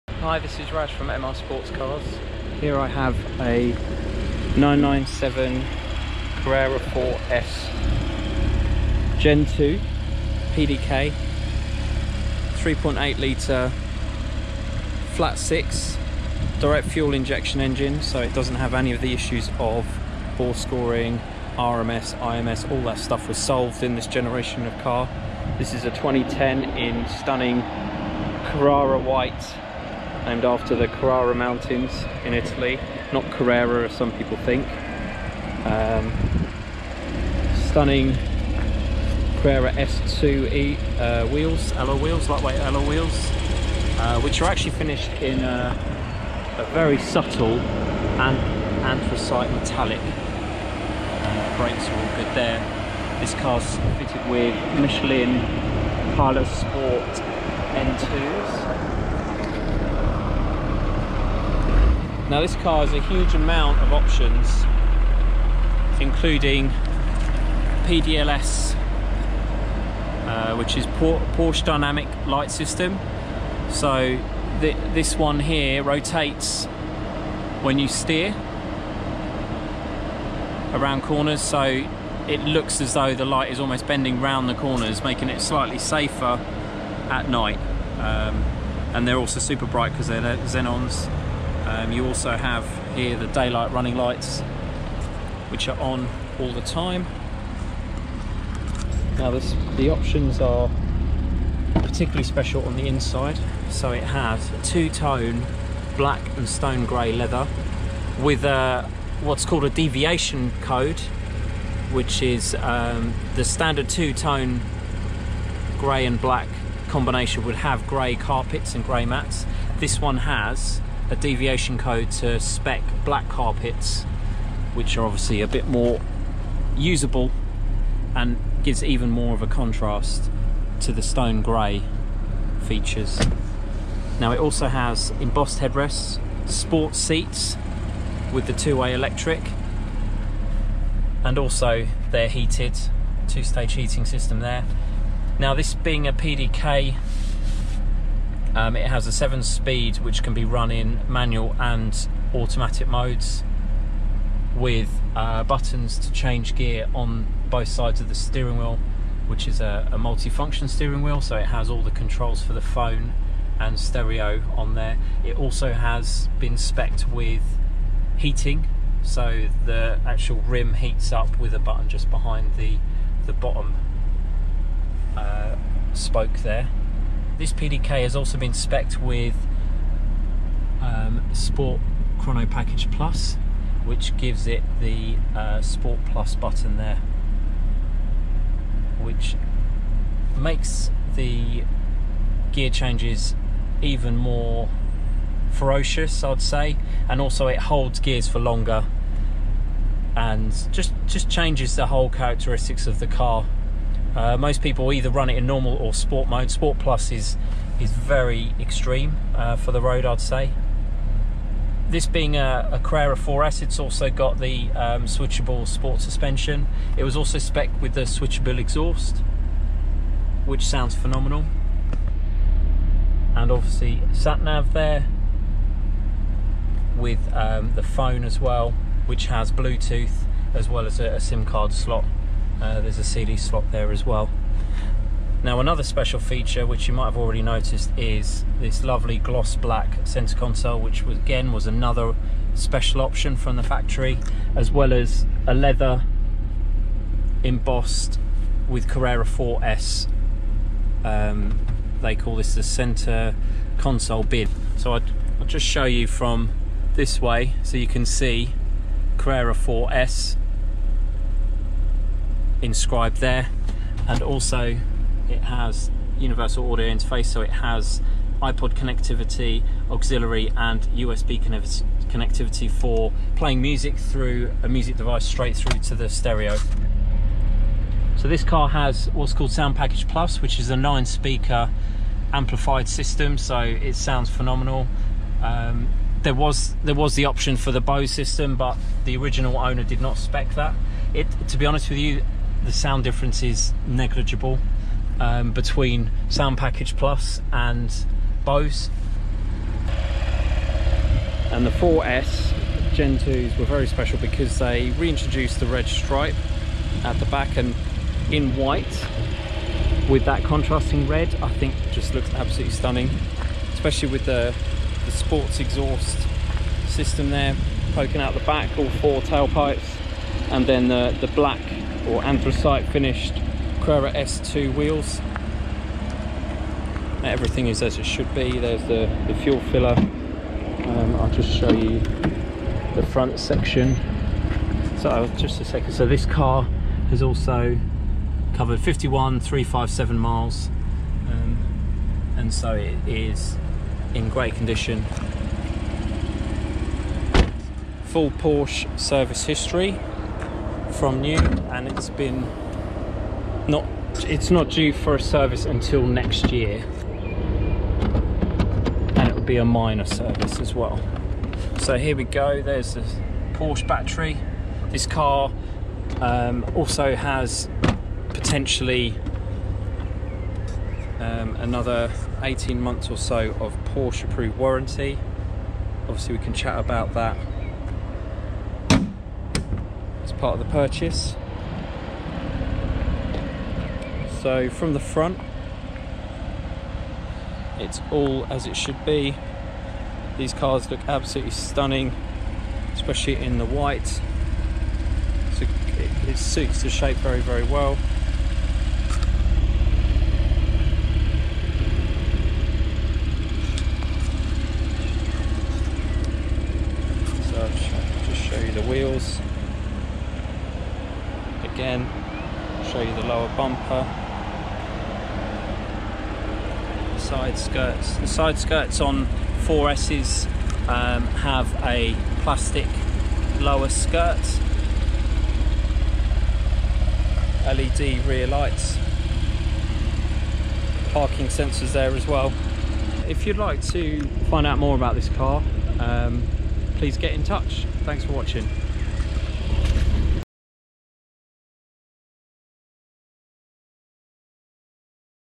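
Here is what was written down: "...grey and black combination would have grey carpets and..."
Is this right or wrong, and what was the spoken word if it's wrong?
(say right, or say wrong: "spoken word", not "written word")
right.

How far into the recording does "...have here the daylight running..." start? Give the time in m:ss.
1:32.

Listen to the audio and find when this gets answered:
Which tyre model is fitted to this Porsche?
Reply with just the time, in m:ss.
0:54.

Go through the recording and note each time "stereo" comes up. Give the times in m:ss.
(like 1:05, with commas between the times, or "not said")
2:43, 4:36.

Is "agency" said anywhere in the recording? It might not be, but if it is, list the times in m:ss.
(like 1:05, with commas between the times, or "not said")
not said.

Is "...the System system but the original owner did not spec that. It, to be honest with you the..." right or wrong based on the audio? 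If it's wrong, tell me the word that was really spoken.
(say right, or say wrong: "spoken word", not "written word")
wrong: "Bose", not "System".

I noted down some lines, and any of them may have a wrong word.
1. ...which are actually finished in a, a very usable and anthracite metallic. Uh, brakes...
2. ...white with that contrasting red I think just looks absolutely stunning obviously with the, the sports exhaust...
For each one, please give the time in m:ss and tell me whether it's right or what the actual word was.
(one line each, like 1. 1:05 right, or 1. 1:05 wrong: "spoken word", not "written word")
1. 0:44 wrong: "subtle", not "usable"
2. 5:08 wrong: "especially", not "obviously".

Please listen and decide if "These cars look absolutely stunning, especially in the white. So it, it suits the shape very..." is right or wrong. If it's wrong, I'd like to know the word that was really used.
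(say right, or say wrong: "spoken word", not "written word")
right.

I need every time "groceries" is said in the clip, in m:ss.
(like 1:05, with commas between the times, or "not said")
not said.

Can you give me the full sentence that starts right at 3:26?
Sport Plus is is very extreme uh, for the road, I'd say.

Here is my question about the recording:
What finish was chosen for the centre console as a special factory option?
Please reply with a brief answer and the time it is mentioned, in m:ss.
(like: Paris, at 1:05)
Gloss black, at 3:59.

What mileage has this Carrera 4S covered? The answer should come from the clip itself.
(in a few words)
51,357 miles.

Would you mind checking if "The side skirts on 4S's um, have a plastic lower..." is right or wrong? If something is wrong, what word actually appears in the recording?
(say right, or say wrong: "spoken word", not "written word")
right.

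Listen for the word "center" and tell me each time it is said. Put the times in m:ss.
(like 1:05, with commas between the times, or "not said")
4:00, 4:12.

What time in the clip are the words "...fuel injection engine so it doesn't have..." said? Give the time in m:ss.
0:16.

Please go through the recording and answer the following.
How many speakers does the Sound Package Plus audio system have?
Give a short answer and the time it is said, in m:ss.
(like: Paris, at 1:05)
9, at 4:40.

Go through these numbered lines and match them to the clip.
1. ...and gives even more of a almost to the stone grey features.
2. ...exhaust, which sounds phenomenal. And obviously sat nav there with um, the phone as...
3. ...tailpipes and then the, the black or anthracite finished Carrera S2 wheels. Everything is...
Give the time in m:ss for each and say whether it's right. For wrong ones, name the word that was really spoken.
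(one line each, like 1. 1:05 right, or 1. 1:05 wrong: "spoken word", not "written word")
1. 2:08 wrong: "contrast", not "almost"
2. 3:38 right
3. 5:19 right.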